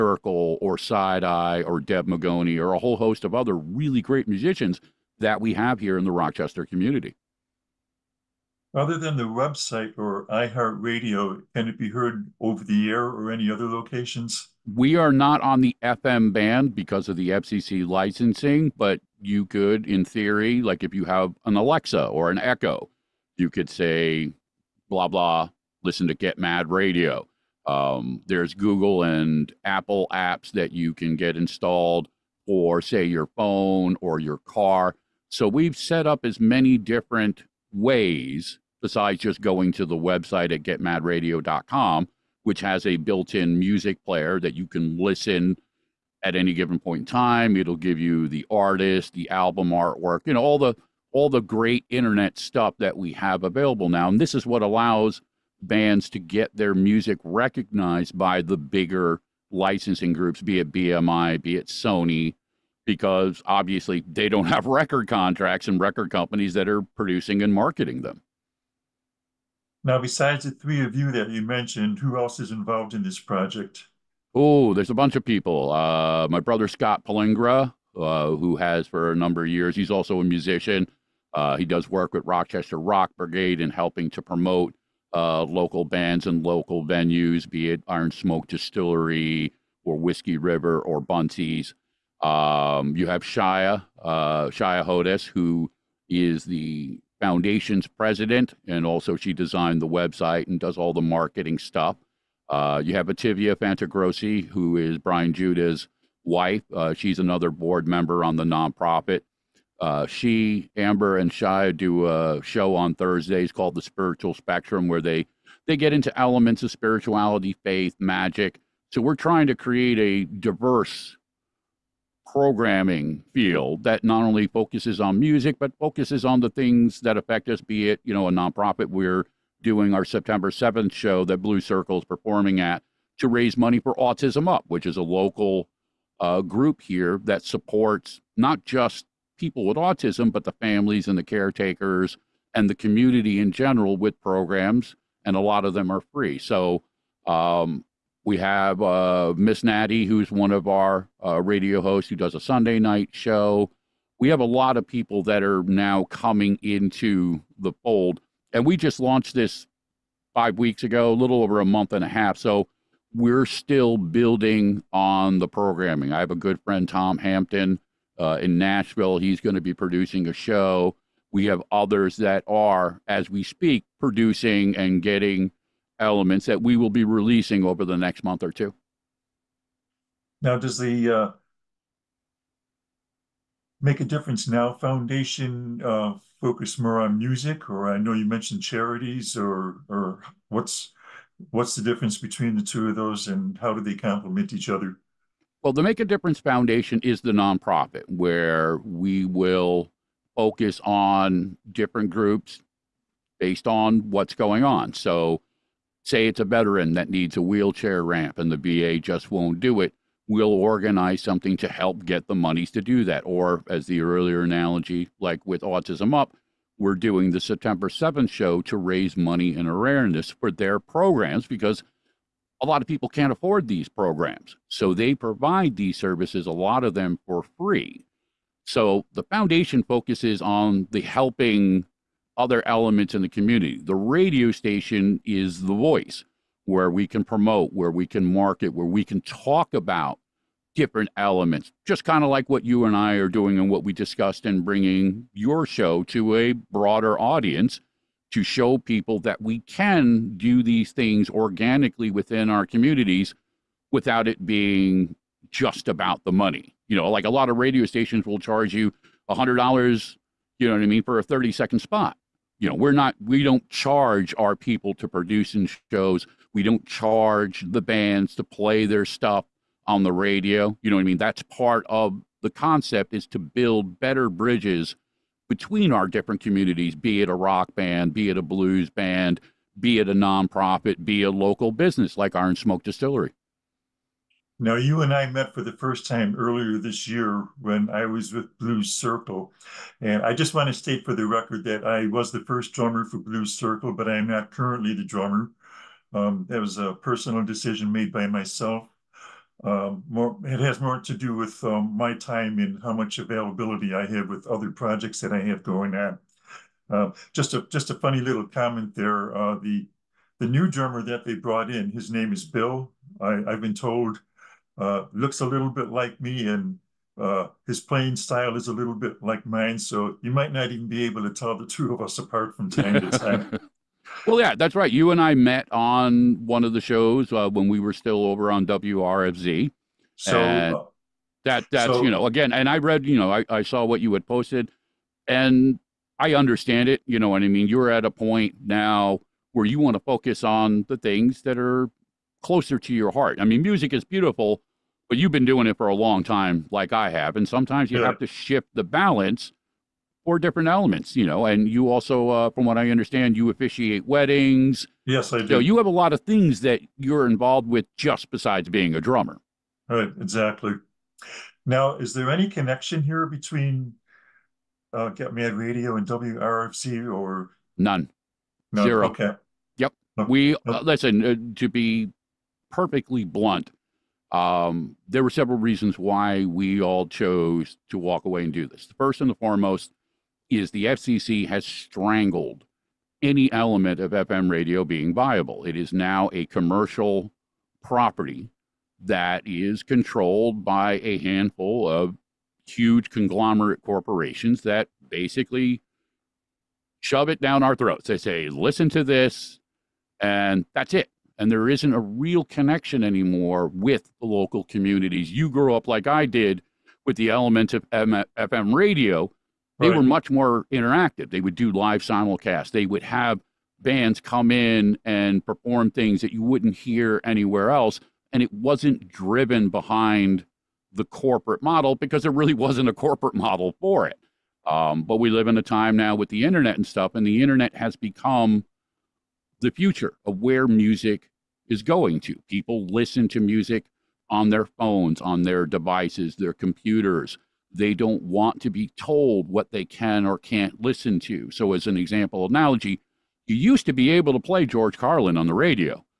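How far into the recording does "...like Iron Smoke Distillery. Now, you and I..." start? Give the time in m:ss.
4:42.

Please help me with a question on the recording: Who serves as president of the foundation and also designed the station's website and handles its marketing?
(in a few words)
Shia Hodes.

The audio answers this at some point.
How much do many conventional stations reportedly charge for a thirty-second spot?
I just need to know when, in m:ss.
4:19.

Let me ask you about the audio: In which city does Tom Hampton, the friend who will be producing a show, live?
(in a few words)
Nashville.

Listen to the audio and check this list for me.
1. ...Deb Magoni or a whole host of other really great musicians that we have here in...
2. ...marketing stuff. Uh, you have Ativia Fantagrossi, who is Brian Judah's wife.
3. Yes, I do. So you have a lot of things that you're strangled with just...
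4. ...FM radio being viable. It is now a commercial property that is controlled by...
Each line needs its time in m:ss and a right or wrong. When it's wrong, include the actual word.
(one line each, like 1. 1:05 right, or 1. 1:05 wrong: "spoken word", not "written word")
1. 0:01 right
2. 1:41 right
3. 5:55 wrong: "involved", not "strangled"
4. 6:24 right.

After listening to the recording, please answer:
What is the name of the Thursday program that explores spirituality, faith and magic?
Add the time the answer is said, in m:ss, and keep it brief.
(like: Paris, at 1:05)
The Spiritual Spectrum, at 1:53.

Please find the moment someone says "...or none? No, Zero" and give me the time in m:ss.
6:07.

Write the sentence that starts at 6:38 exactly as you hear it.
They say, listen to this, and that's it.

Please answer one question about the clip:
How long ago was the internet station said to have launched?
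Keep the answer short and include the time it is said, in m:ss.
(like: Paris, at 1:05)
5 weeks ago, at 2:40.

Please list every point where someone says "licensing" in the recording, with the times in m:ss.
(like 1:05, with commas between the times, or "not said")
0:17, 0:59.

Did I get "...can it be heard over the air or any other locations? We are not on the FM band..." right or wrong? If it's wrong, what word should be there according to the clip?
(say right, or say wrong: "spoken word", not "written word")
right.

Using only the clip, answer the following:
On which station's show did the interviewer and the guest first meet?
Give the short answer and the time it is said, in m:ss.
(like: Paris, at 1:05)
WRFZ, at 5:28.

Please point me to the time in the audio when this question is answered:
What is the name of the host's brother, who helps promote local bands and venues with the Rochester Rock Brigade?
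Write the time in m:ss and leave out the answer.
1:16.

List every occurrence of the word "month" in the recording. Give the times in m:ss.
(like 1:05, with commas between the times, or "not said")
2:41, 2:58.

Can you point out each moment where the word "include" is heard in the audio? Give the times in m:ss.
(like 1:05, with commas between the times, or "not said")
not said.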